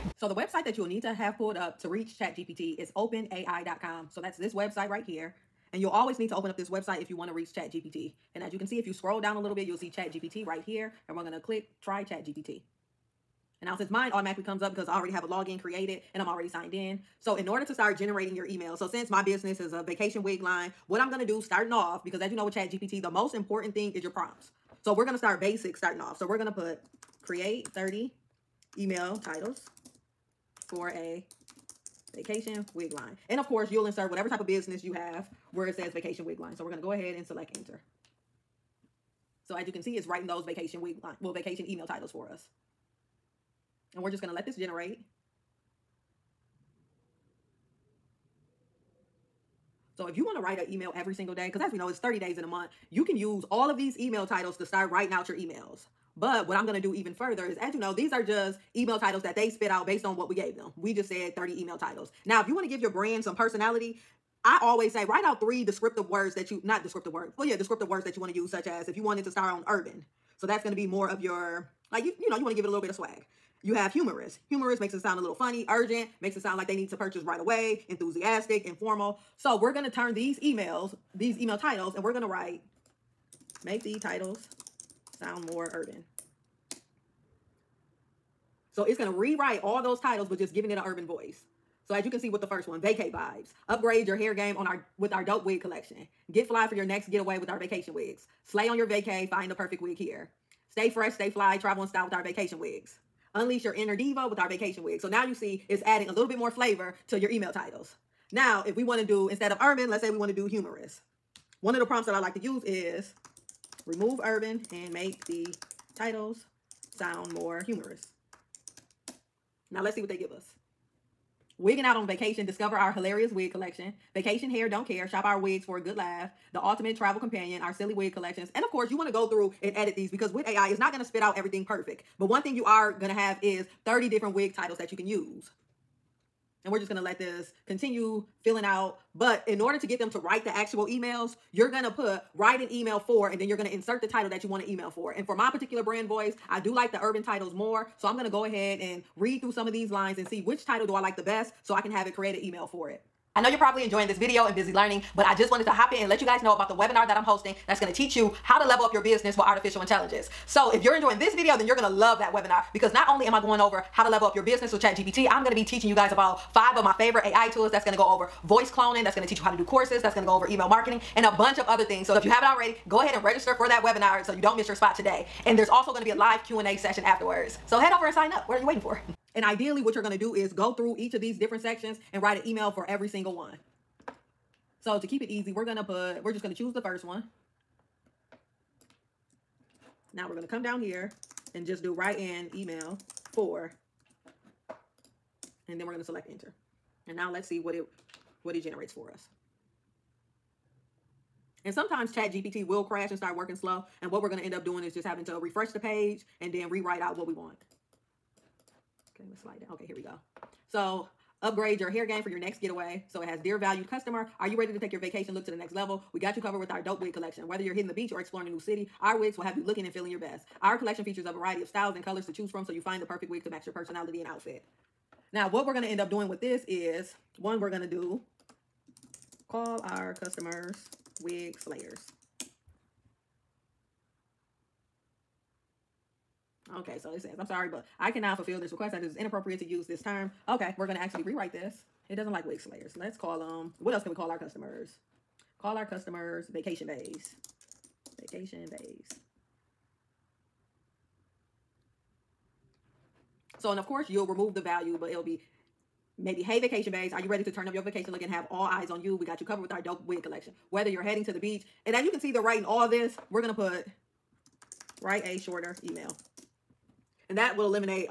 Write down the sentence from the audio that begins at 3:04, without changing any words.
So to keep it easy, we're going to put, we're just going to choose the first one.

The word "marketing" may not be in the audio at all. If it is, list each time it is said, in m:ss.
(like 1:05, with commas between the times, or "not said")
2:50.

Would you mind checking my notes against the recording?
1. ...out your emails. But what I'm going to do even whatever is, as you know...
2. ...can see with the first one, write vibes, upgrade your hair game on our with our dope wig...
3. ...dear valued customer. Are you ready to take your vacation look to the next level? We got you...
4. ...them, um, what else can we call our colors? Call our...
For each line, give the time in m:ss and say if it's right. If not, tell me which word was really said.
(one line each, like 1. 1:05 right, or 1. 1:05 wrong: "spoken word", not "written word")
1. 0:55 wrong: "further", not "whatever"
2. 1:32 wrong: "vacate", not "write"
3. 3:33 right
4. 4:03 wrong: "customers", not "colors".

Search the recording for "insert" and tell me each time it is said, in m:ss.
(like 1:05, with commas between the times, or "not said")
0:33, 2:23.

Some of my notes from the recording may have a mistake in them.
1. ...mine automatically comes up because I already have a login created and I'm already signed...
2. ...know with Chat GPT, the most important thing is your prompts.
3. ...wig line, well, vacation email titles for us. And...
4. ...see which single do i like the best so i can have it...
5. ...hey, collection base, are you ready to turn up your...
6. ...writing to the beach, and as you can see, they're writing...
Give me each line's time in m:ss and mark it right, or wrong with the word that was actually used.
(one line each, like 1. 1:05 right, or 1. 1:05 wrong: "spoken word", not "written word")
1. 0:13 right
2. 0:22 right
3. 0:40 right
4. 2:30 wrong: "title", not "single"
5. 4:16 wrong: "vacation", not "collection"
6. 4:21 wrong: "heading", not "writing".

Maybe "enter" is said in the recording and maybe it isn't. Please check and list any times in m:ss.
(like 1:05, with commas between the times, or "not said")
0:37, 3:16.